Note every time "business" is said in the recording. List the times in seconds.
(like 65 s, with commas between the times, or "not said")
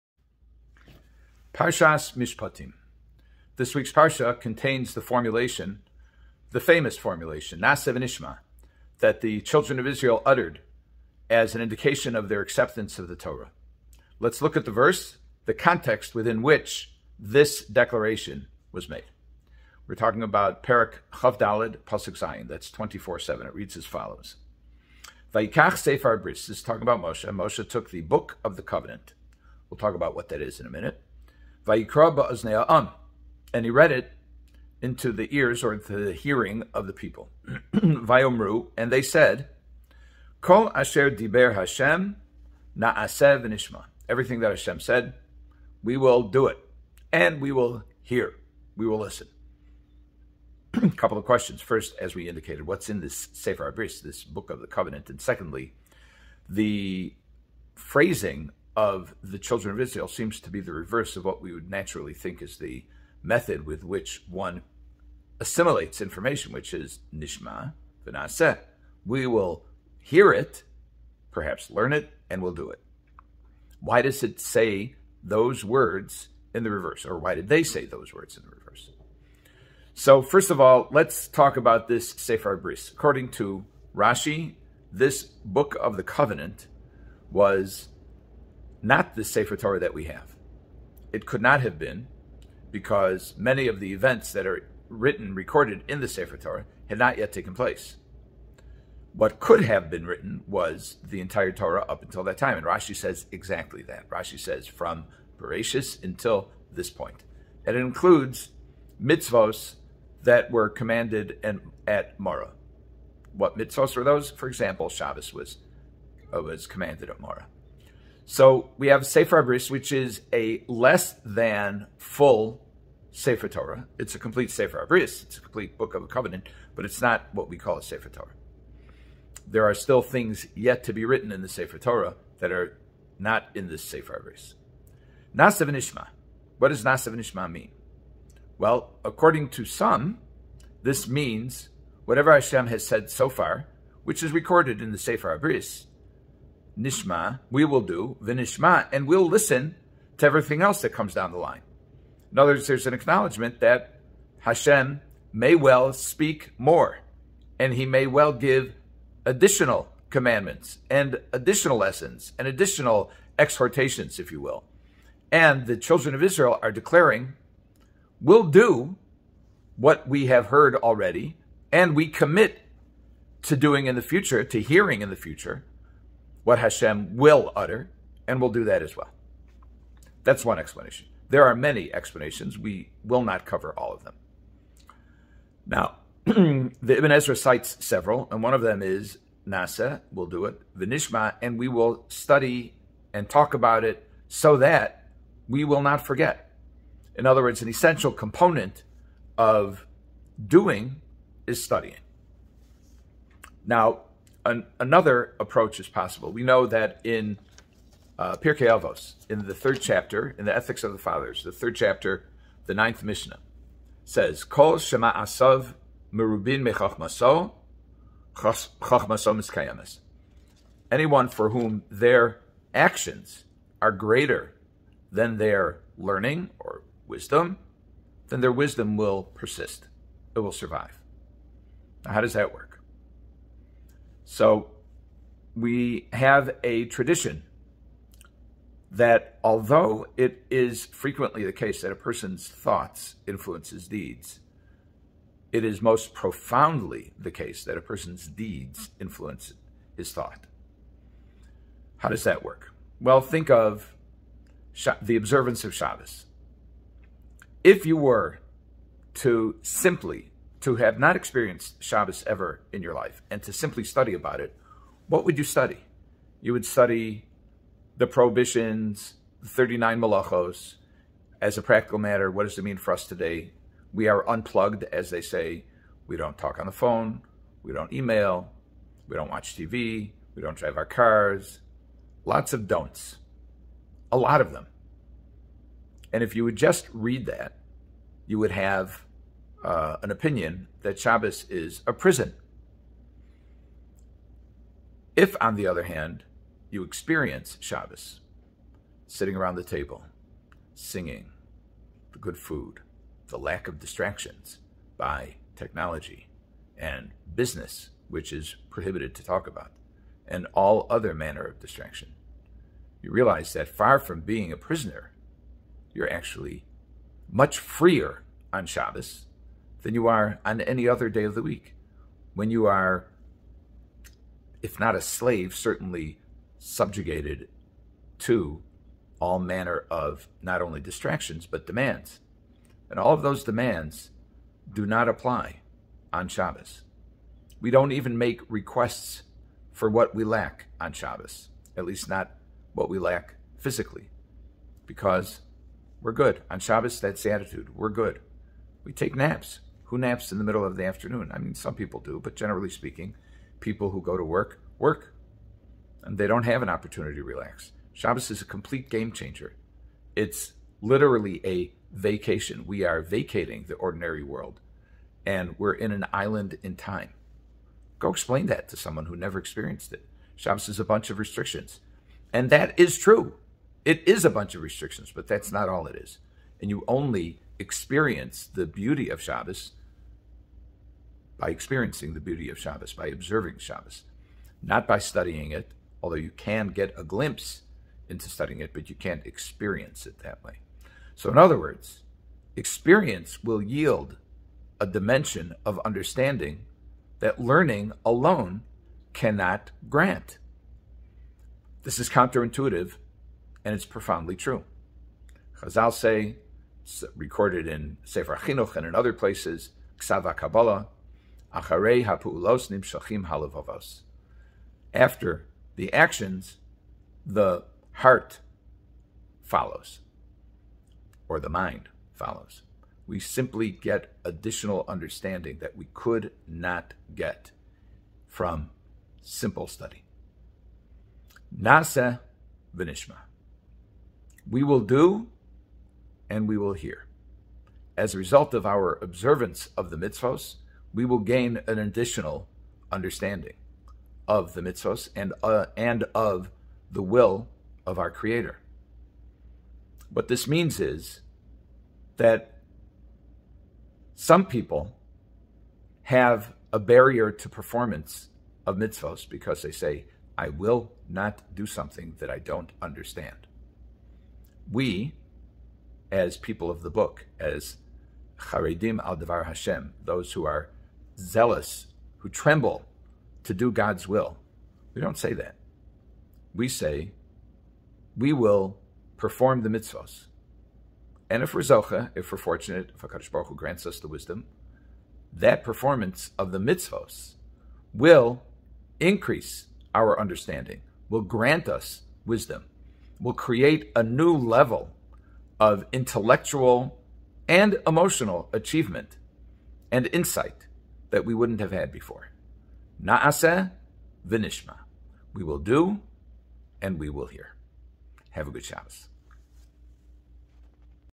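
307 s.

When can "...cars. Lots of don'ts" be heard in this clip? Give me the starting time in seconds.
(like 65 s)
280 s.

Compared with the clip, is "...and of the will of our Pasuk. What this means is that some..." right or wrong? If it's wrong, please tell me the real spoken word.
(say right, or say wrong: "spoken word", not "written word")
wrong: "Creator", not "Pasuk".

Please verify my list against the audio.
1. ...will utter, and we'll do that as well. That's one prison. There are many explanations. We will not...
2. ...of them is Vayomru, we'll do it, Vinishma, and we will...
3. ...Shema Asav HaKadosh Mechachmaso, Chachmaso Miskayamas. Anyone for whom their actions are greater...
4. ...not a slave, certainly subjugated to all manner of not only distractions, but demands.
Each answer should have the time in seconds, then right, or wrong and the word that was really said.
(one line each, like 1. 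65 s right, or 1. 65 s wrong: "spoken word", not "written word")
1. 177 s wrong: "explanation", not "prison"
2. 188 s wrong: "Nasa", not "Vayomru"
3. 214 s wrong: "Merubin", not "HaKadosh"
4. 324 s right.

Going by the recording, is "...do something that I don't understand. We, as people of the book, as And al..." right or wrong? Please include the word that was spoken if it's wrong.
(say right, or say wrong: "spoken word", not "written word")
wrong: "Charedim", not "And".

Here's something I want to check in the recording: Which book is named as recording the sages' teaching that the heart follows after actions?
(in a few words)
Sefer Chinuch.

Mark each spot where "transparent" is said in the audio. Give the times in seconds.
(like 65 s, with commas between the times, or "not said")
not said.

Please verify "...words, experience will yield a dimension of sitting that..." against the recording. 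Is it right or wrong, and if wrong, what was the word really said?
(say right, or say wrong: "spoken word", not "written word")
wrong: "understanding", not "sitting".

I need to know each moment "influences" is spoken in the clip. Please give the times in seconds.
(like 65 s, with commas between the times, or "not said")
243 s, 248 s.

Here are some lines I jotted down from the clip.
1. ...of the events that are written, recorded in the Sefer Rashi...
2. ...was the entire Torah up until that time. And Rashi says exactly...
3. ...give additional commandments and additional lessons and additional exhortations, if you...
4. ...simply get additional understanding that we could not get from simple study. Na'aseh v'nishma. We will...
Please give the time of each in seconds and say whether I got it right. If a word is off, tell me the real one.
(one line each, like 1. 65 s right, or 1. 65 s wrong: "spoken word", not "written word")
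1. 93 s wrong: "Torah", not "Rashi"
2. 100 s right
3. 158 s right
4. 423 s right.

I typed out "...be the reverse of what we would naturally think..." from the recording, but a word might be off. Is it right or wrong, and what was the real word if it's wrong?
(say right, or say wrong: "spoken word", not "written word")
right.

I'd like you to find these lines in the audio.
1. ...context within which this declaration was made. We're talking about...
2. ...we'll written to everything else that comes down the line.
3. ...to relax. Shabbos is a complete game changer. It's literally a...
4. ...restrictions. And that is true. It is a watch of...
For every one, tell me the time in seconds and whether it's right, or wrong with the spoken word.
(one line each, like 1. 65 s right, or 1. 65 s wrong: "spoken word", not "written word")
1. 15 s right
2. 149 s wrong: "listen", not "written"
3. 357 s right
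4. 371 s wrong: "bunch", not "watch".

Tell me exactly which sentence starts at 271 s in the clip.
As a practical matter, what does it mean for us today?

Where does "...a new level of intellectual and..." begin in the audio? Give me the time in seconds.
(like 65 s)
493 s.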